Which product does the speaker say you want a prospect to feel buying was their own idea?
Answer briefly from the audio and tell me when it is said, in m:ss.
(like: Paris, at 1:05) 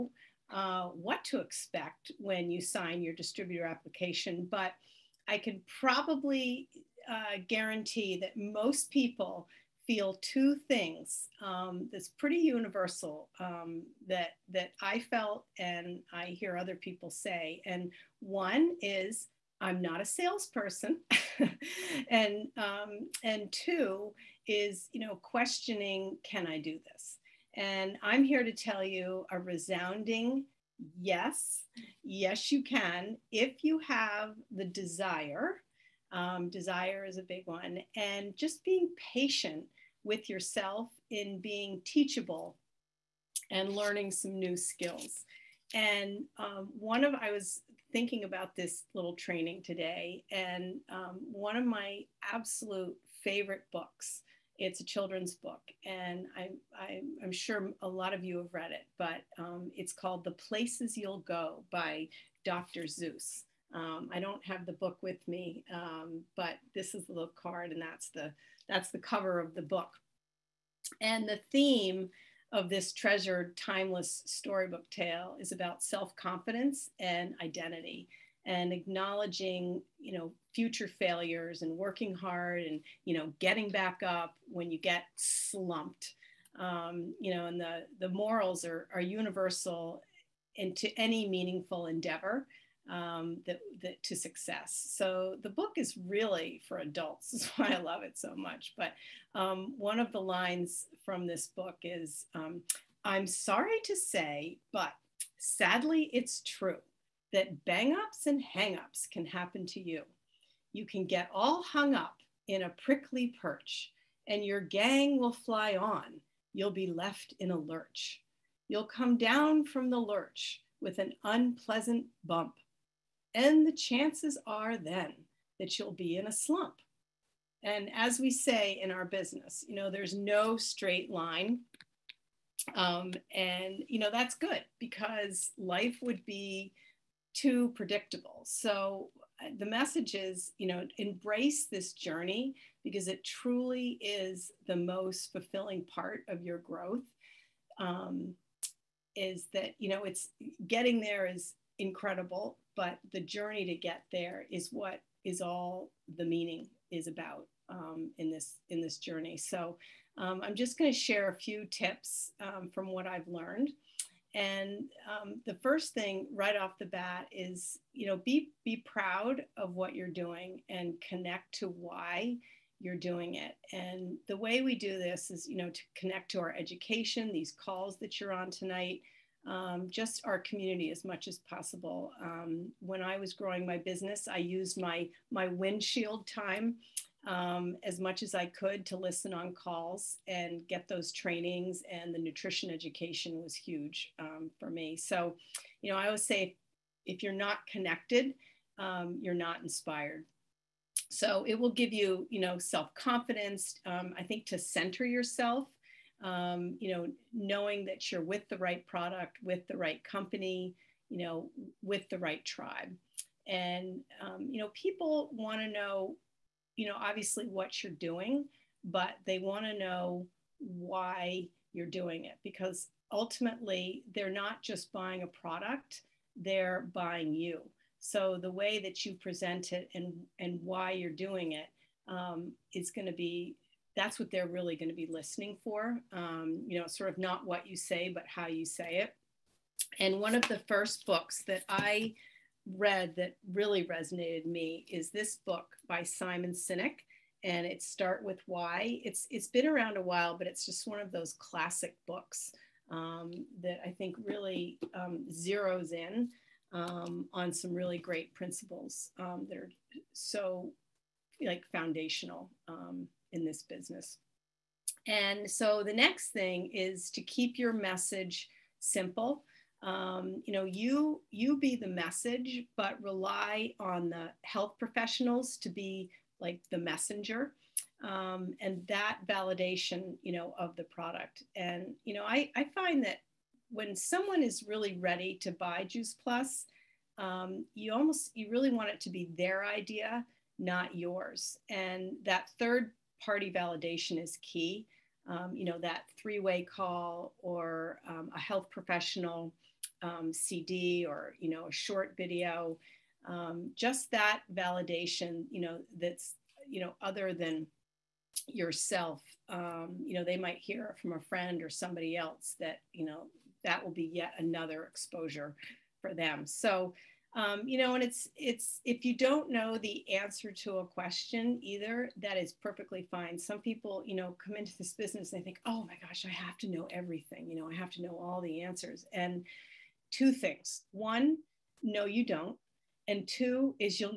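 Juice Plus, at 4:45.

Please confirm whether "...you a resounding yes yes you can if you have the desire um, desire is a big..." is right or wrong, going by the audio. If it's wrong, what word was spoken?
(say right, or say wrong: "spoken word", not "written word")
right.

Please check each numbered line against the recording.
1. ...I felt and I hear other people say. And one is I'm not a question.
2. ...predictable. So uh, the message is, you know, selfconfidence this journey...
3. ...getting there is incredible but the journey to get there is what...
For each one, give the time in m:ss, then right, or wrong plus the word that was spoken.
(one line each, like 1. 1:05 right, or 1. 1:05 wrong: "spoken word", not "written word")
1. 0:14 wrong: "salesperson", not "question"
2. 2:17 wrong: "embrace", not "selfconfidence"
3. 2:30 right.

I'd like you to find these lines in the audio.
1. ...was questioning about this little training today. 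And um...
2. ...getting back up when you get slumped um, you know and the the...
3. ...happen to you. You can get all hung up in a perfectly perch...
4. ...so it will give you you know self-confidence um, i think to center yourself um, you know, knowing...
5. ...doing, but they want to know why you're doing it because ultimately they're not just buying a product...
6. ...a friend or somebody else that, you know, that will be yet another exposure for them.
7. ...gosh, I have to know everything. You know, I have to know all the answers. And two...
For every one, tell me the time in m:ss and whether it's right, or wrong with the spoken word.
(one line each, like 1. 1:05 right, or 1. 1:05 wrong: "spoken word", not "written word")
1. 0:47 wrong: "thinking", not "questioning"
2. 1:23 right
3. 1:49 wrong: "prickly", not "perfectly"
4. 3:21 right
5. 3:37 right
6. 5:11 right
7. 5:26 right.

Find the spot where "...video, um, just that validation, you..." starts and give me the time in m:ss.
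5:02.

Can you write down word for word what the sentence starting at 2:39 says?
So um, I'm just going to share a few tips um, from what I've learned.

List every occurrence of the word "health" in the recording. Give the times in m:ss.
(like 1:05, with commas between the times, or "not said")
4:34, 4:58.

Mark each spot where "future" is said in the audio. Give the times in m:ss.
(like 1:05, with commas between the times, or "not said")
1:20.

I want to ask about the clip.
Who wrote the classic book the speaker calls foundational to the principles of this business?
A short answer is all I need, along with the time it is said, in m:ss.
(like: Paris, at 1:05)
Simon Sinek, at 4:06.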